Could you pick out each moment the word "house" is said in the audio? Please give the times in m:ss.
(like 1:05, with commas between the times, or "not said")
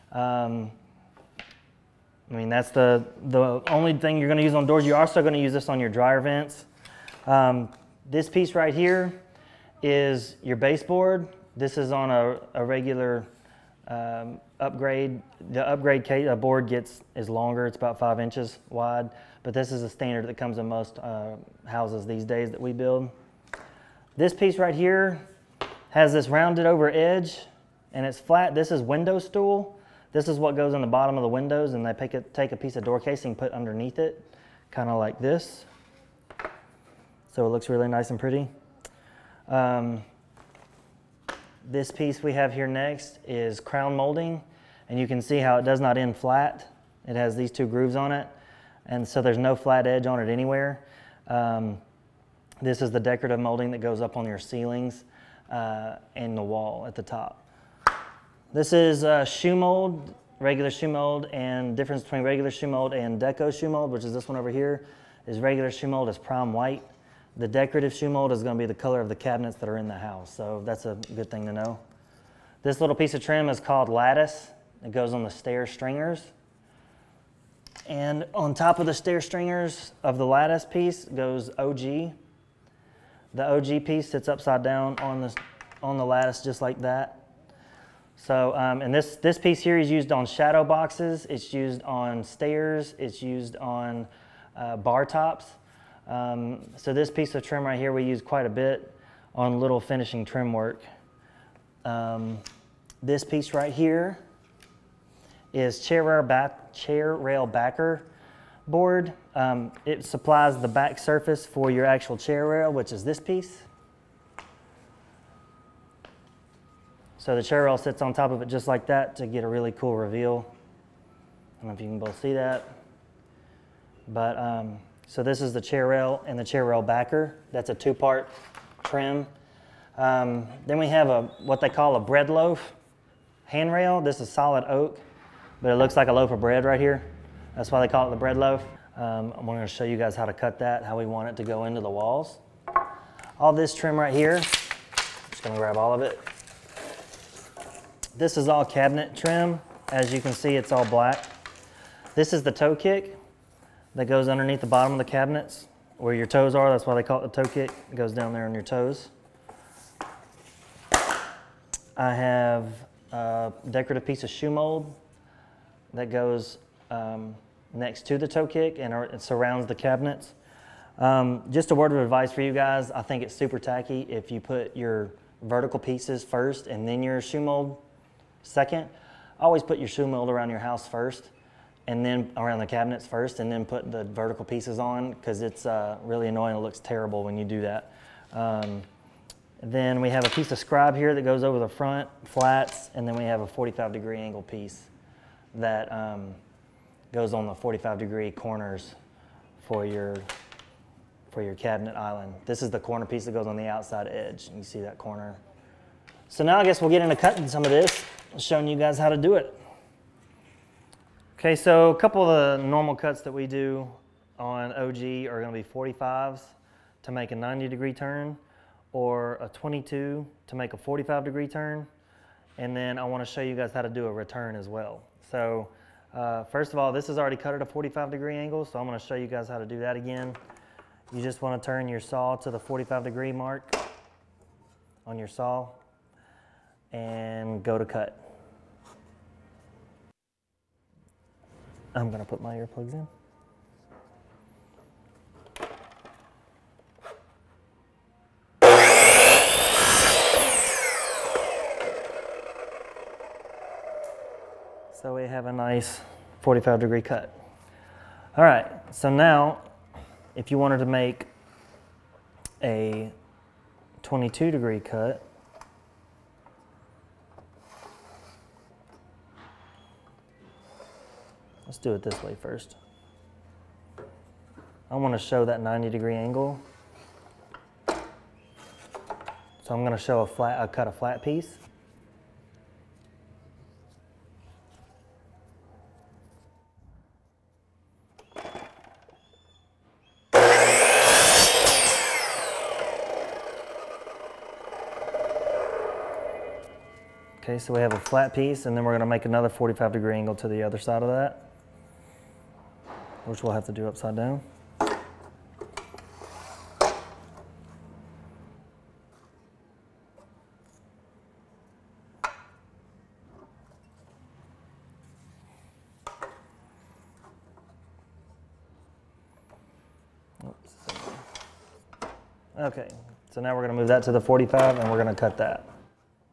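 0:21, 1:09, 3:00.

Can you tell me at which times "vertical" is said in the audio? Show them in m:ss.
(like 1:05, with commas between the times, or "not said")
2:55, 3:04.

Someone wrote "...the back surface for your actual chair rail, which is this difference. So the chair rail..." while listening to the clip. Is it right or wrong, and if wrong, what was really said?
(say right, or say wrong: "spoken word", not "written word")
wrong: "piece", not "difference".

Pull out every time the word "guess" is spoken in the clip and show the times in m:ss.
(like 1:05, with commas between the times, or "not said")
3:26.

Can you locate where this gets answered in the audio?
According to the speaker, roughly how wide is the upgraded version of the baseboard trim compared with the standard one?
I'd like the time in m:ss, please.
0:17.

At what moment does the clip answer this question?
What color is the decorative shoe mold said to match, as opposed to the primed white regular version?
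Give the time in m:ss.
1:08.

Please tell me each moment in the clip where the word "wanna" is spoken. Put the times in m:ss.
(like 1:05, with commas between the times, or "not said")
3:43, 3:51, 4:34.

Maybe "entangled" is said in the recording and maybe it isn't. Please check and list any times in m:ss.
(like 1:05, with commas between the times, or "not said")
not said.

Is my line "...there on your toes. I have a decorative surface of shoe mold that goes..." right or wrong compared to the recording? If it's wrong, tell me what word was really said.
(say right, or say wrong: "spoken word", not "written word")
wrong: "piece", not "surface".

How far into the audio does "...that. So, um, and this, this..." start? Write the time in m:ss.
1:26.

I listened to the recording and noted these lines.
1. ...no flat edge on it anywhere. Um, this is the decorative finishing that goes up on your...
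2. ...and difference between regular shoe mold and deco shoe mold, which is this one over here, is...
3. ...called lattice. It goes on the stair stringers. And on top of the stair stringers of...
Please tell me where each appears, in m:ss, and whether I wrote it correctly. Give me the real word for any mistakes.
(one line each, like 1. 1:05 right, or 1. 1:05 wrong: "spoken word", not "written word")
1. 0:49 wrong: "molding", not "finishing"
2. 1:01 right
3. 1:13 right.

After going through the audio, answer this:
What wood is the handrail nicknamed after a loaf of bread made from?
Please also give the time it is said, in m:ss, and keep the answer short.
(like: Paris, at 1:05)
Solid oak, at 2:14.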